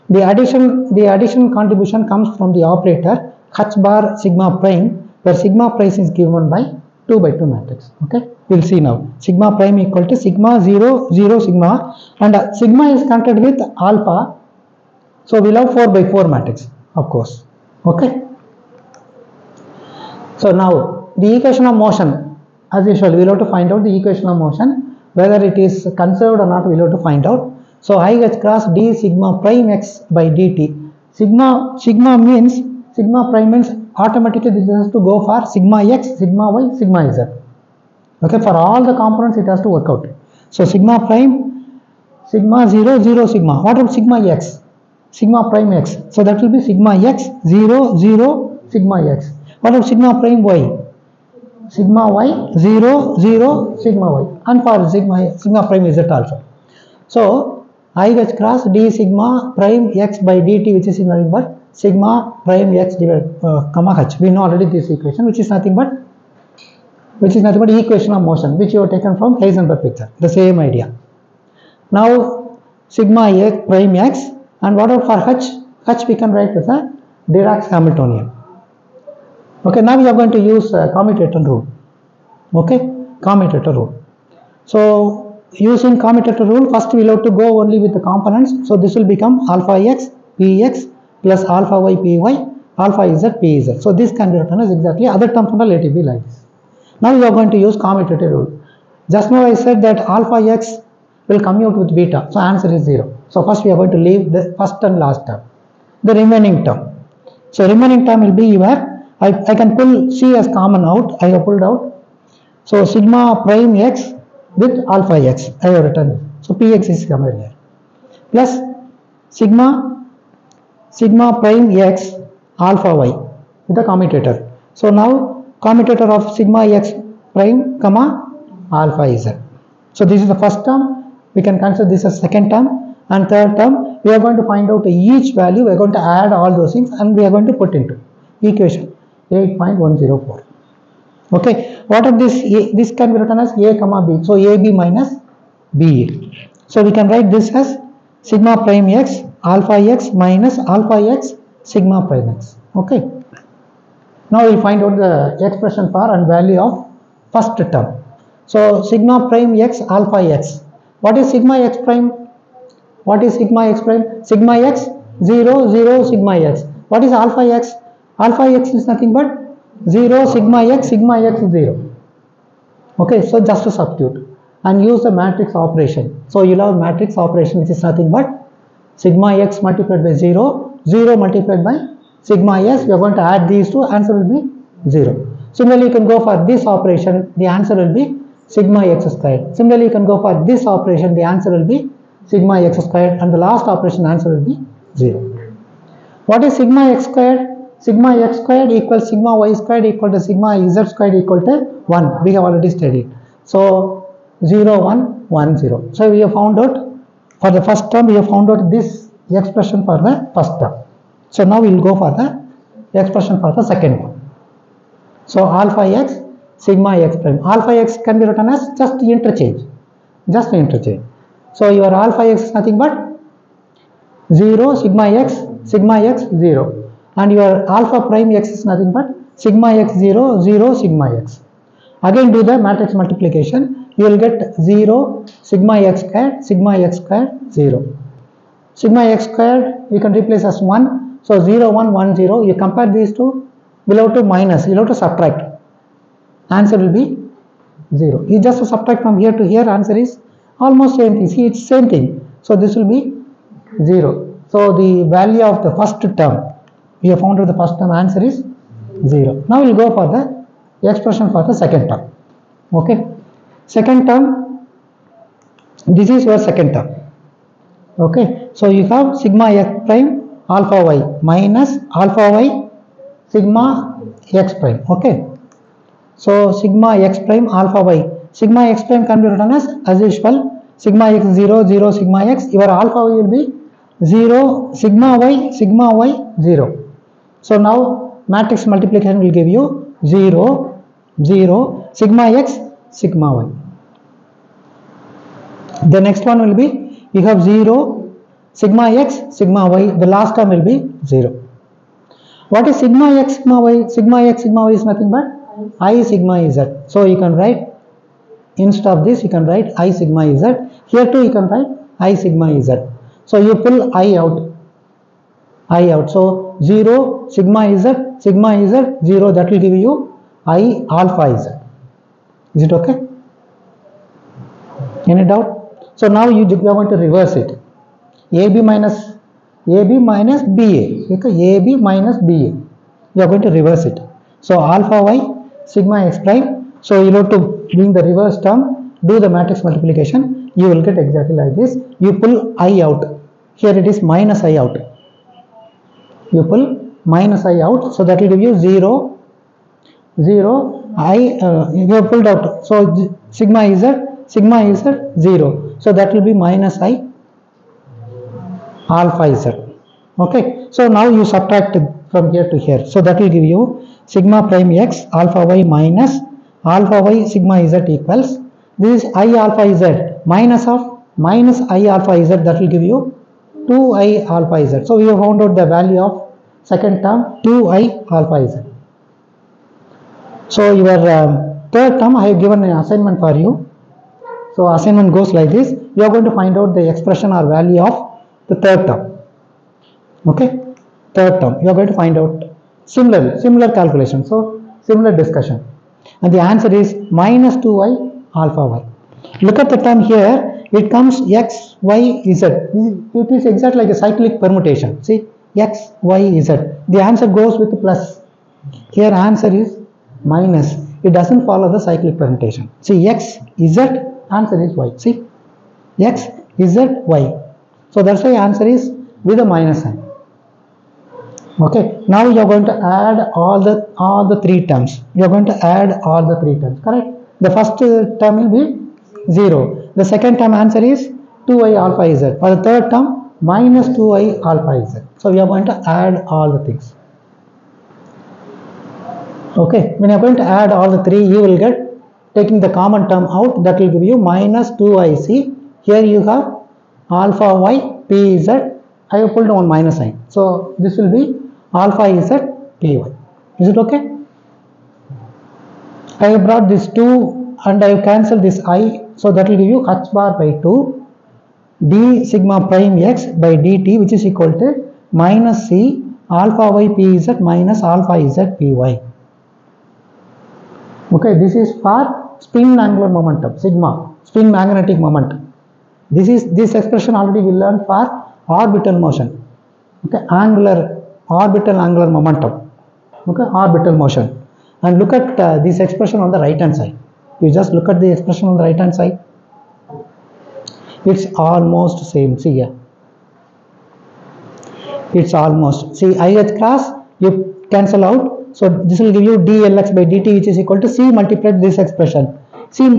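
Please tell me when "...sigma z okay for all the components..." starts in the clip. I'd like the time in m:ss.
0:36.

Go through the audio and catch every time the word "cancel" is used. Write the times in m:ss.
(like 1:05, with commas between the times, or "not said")
7:38, 8:17.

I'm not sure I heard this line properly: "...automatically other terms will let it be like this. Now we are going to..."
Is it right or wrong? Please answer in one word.
wrong.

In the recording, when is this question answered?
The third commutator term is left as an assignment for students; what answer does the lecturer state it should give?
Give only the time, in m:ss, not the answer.
6:37.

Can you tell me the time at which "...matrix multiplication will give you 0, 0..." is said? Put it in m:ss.
4:48.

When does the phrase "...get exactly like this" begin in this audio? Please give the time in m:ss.
5:40.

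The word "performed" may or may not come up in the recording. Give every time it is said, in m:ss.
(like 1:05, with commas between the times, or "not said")
not said.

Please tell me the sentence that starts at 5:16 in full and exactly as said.
So 0 sigma is a sigma is a 0 that will give you I alpha is a.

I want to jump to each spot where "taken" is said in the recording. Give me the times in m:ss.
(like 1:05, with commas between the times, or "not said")
1:08.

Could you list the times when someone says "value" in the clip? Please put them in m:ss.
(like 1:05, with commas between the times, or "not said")
2:15, 2:36, 4:15, 6:15, 6:27.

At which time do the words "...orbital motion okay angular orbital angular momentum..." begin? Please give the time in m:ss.
7:58.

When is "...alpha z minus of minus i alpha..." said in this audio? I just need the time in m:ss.
6:09.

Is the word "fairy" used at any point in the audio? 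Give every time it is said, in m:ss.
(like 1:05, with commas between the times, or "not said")
not said.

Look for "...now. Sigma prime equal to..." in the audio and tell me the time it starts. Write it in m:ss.
0:08.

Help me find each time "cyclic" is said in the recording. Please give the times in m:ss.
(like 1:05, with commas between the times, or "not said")
6:43, 6:51.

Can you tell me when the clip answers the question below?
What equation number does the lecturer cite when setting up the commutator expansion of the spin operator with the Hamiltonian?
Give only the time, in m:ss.
2:19.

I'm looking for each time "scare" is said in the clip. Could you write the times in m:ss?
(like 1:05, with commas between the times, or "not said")
not said.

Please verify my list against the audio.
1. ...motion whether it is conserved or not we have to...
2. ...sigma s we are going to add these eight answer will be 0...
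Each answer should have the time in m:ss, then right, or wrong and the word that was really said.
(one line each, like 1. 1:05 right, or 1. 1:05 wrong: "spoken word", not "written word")
1. 0:24 right
2. 3:02 wrong: "two", not "eight".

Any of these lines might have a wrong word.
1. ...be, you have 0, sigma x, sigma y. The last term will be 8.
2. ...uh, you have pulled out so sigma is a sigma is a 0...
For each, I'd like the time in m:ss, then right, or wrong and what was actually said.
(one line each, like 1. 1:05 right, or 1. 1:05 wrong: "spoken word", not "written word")
1. 4:56 wrong: "0", not "8"
2. 5:51 right.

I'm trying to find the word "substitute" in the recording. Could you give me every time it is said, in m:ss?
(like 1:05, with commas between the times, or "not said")
2:53.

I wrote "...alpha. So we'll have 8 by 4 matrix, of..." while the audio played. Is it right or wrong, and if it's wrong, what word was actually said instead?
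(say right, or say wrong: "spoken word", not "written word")
wrong: "4", not "8".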